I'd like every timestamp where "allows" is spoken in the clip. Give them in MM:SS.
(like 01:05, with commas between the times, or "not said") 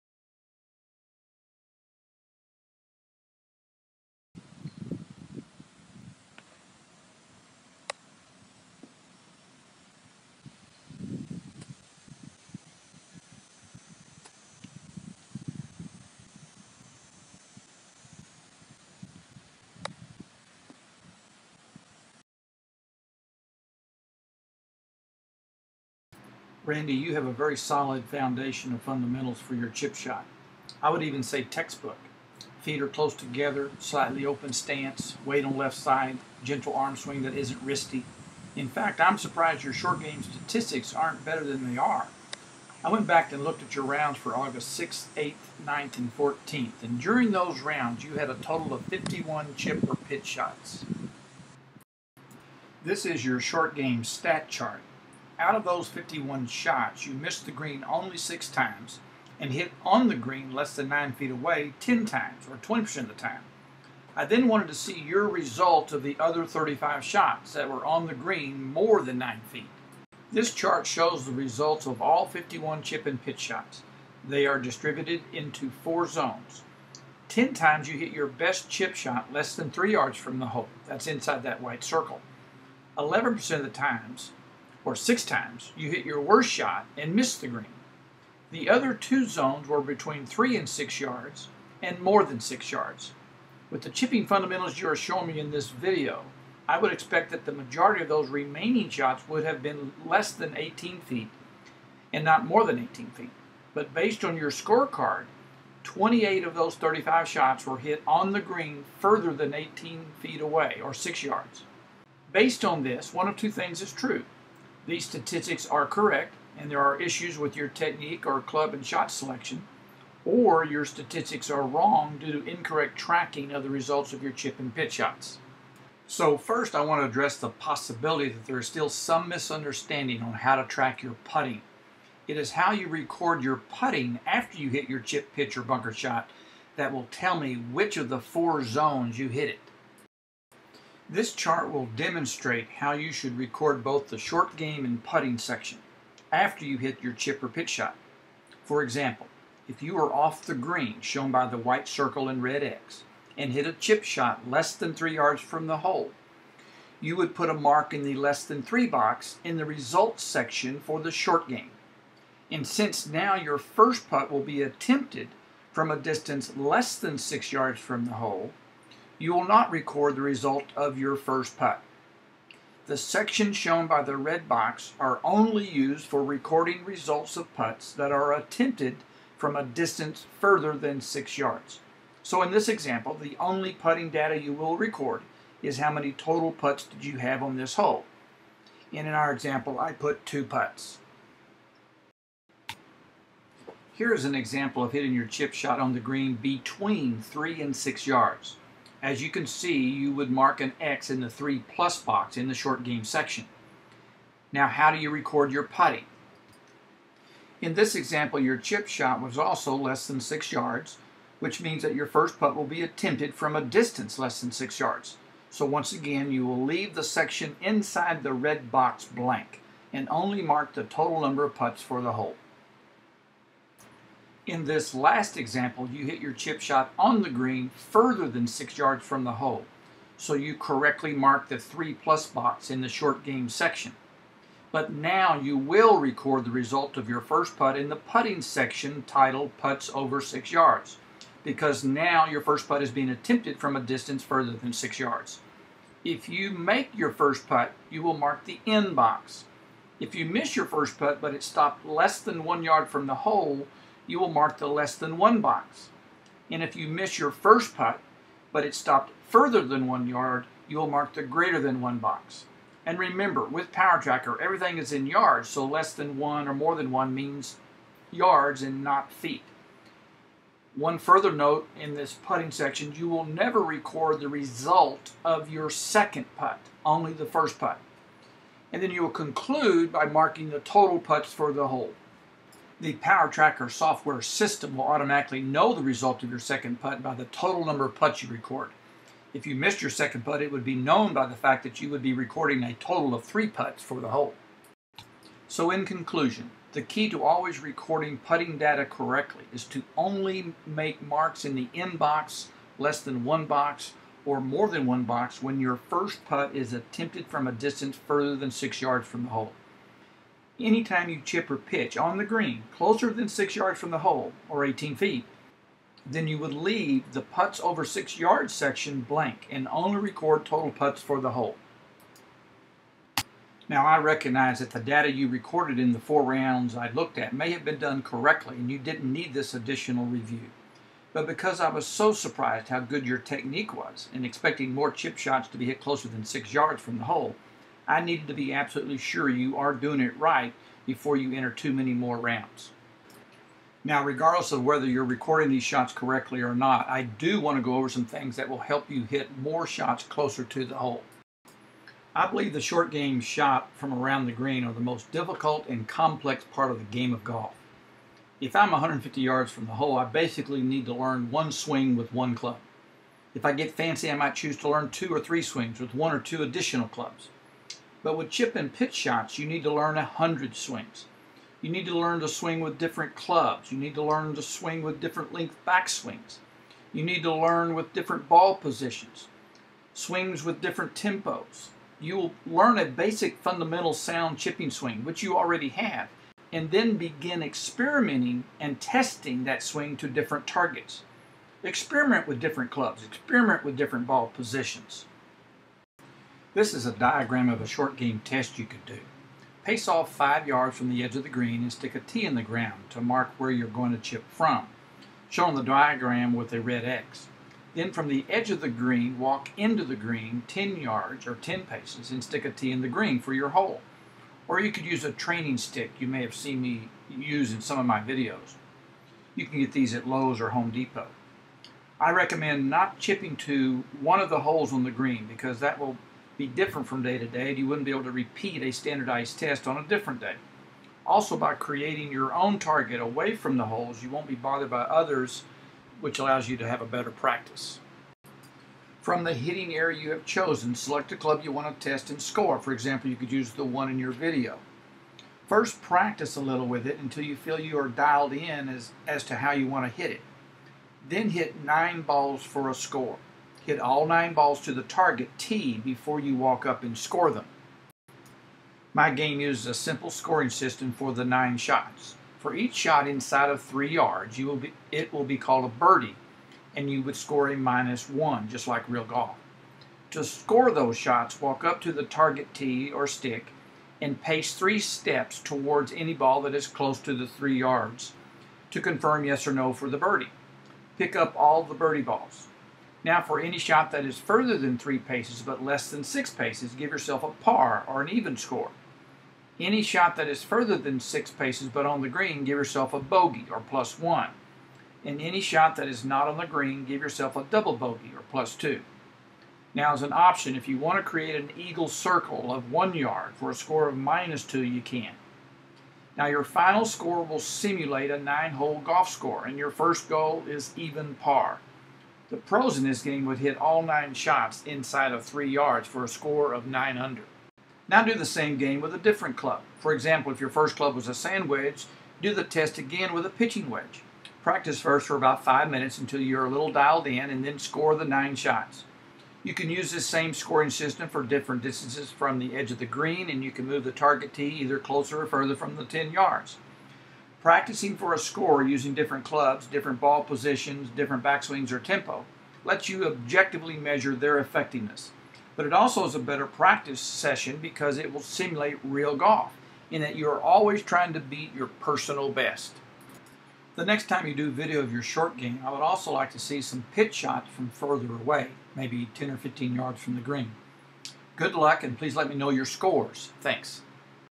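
07:16.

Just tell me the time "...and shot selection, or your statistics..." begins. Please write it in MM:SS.
01:58.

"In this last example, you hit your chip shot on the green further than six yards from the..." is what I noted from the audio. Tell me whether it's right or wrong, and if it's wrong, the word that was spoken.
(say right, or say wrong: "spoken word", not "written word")
right.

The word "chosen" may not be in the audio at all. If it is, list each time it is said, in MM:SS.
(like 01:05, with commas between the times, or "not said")
07:20.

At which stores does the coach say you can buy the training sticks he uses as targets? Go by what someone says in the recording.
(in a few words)
Lowe's or Home Depot.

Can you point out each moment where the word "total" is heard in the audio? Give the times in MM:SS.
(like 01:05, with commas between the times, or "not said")
00:48, 03:06, 03:40, 04:40, 04:47, 04:52, 05:20.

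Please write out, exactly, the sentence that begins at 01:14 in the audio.
They are distributed into four zones.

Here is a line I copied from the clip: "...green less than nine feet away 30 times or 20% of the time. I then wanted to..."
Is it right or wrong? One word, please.
wrong.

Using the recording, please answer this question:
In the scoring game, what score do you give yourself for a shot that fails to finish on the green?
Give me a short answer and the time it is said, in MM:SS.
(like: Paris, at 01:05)
plus 2 (double bogey), at 08:17.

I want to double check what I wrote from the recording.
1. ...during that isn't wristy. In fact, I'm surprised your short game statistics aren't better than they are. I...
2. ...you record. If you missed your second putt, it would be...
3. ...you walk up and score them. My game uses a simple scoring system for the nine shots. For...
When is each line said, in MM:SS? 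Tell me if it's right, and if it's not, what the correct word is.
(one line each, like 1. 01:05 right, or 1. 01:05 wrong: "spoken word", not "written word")
1. 00:36 wrong: "swing", not "during"
2. 04:48 right
3. 07:36 right.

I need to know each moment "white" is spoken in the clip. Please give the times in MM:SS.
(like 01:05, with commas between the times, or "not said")
01:21, 02:31.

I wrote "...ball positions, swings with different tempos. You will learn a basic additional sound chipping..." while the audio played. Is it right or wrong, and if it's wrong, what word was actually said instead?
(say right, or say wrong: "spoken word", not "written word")
wrong: "fundamental", not "additional".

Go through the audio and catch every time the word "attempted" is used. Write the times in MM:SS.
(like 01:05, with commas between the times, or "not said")
02:44, 02:58, 03:32, 04:03, 05:06.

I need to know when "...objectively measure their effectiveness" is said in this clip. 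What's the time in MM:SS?
09:03.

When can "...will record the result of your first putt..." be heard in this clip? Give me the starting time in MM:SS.
03:55.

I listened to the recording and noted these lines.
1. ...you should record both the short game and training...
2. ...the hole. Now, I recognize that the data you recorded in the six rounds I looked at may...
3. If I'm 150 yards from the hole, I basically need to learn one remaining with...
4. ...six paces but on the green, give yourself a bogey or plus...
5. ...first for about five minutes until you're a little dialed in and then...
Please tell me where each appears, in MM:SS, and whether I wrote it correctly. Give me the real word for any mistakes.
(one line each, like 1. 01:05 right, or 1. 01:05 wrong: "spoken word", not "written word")
1. 02:22 wrong: "putting", not "training"
2. 05:21 wrong: "four", not "six"
3. 05:58 wrong: "swing", not "remaining"
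4. 08:10 right
5. 08:44 right.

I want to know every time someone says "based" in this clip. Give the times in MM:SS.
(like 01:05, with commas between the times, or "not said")
01:43, 01:52.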